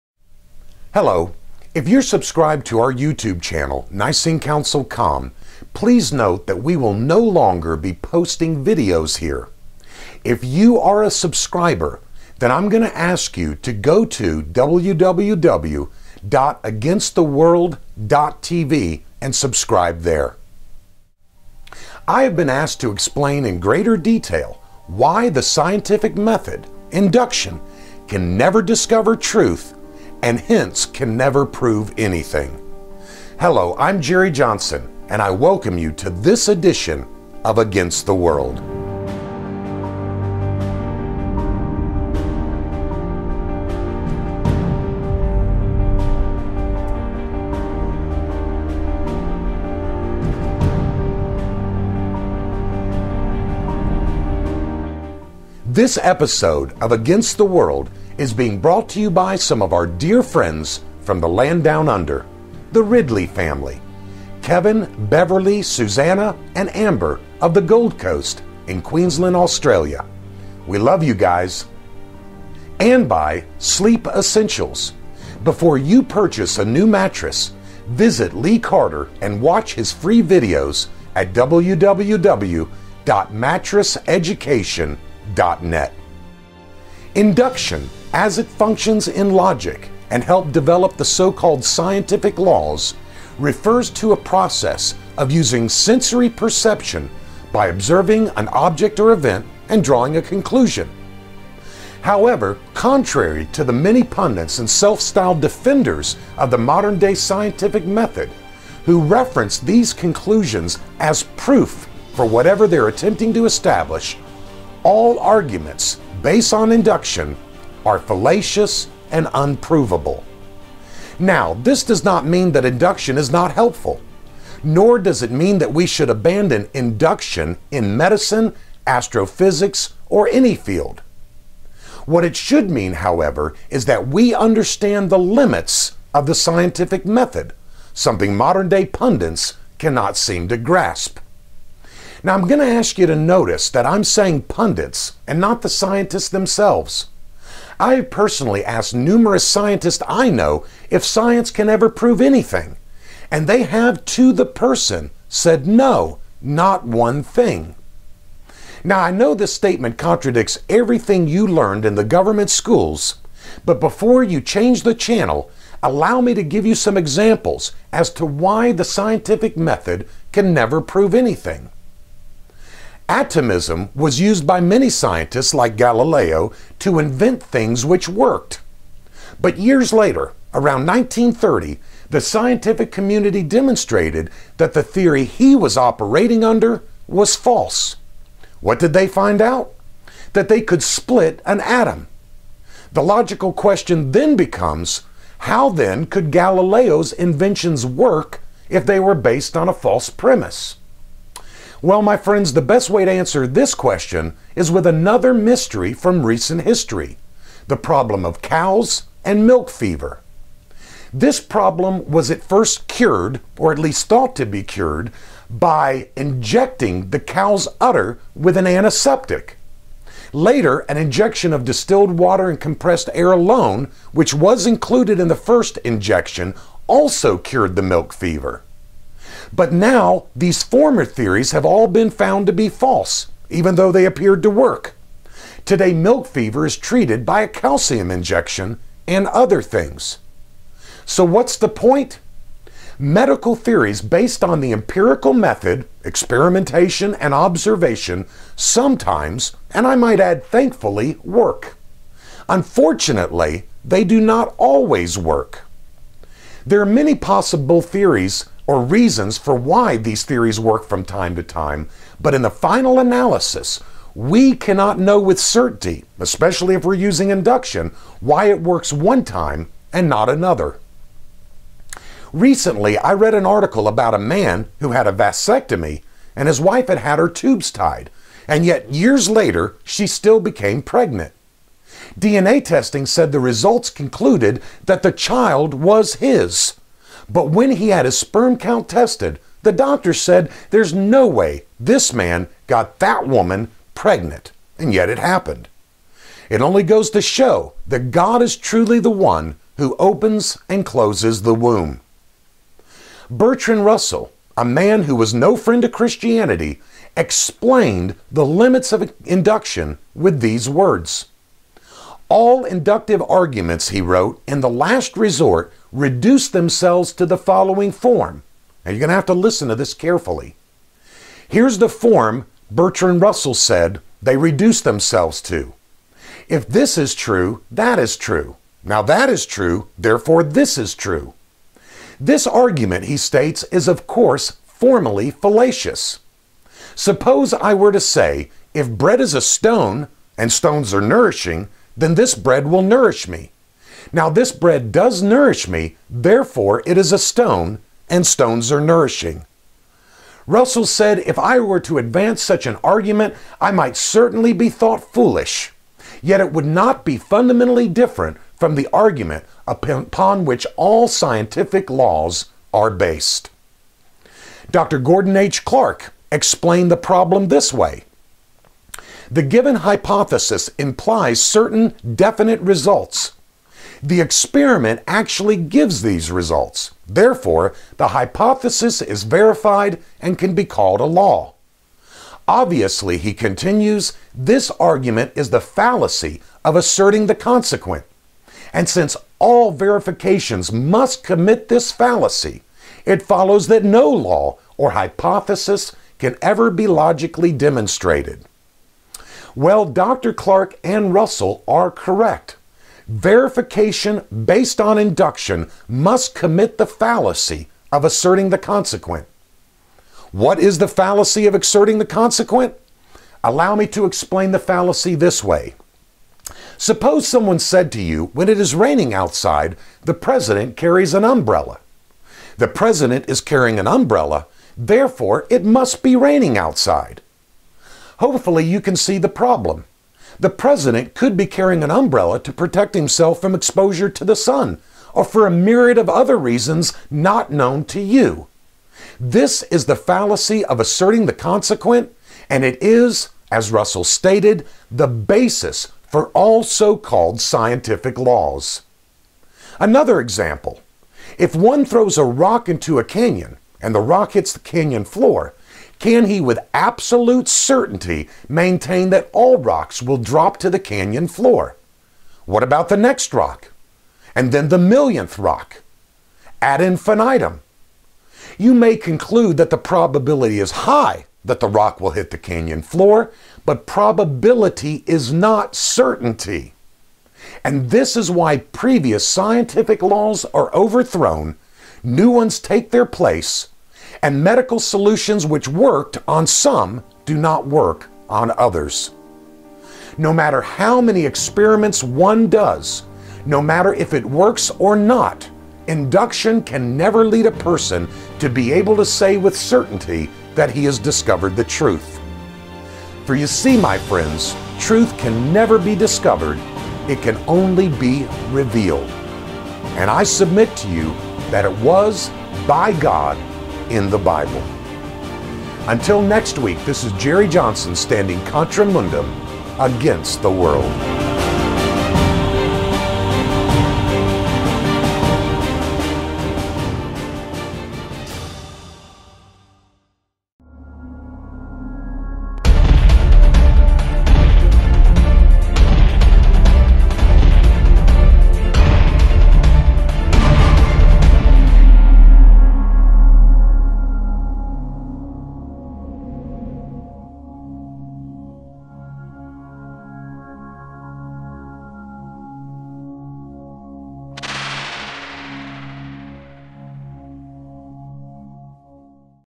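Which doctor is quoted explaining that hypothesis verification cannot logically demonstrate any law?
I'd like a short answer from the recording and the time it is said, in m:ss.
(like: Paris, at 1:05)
Gordon H. Clark, at 6:04.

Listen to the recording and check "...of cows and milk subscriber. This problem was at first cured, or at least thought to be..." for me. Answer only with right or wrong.
wrong.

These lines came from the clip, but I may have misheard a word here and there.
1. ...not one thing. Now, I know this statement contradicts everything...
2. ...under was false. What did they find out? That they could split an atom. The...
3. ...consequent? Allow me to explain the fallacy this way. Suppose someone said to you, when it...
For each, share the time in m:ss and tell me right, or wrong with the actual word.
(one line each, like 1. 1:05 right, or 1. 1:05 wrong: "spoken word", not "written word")
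1. 2:36 right
2. 3:06 right
3. 6:52 right.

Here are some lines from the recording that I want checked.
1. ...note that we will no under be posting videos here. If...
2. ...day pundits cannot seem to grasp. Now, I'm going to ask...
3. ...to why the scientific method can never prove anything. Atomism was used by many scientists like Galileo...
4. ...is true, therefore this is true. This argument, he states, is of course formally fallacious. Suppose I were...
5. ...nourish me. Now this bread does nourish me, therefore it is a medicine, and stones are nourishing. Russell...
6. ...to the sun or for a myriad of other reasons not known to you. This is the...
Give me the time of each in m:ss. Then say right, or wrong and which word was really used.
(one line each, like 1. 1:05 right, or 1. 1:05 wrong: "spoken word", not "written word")
1. 0:06 wrong: "longer", not "under"
2. 2:18 right
3. 2:48 right
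4. 5:29 right
5. 5:42 wrong: "stone", not "medicine"
6. 7:14 right.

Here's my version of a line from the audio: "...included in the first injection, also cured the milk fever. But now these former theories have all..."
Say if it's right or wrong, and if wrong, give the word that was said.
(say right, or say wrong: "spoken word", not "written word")
right.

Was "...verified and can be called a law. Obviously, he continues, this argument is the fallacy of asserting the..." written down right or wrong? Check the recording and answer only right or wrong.
right.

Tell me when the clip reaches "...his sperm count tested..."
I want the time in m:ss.
4:48.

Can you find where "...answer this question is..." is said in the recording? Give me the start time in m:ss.
3:23.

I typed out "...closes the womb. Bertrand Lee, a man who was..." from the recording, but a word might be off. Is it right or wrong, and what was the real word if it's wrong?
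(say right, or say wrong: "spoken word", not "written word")
wrong: "Russell", not "Lee".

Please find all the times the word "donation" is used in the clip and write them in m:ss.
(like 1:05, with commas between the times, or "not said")
not said.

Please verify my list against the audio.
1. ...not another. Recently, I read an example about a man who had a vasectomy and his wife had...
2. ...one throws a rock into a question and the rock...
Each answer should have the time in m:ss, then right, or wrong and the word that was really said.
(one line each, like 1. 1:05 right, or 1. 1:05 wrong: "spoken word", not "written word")
1. 4:30 wrong: "article", not "example"
2. 7:31 wrong: "canyon", not "question".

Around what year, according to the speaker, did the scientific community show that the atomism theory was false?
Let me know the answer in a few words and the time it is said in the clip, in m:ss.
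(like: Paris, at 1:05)
1930, at 3:00.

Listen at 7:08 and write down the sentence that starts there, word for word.
Hopefully, you can see the problem.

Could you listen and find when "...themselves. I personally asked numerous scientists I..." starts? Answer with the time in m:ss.
2:26.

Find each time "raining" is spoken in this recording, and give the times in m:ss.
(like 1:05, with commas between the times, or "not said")
6:58, 7:06.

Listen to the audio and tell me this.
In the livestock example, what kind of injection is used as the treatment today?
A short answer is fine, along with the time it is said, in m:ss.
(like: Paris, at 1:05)
Calcium injection, at 3:57.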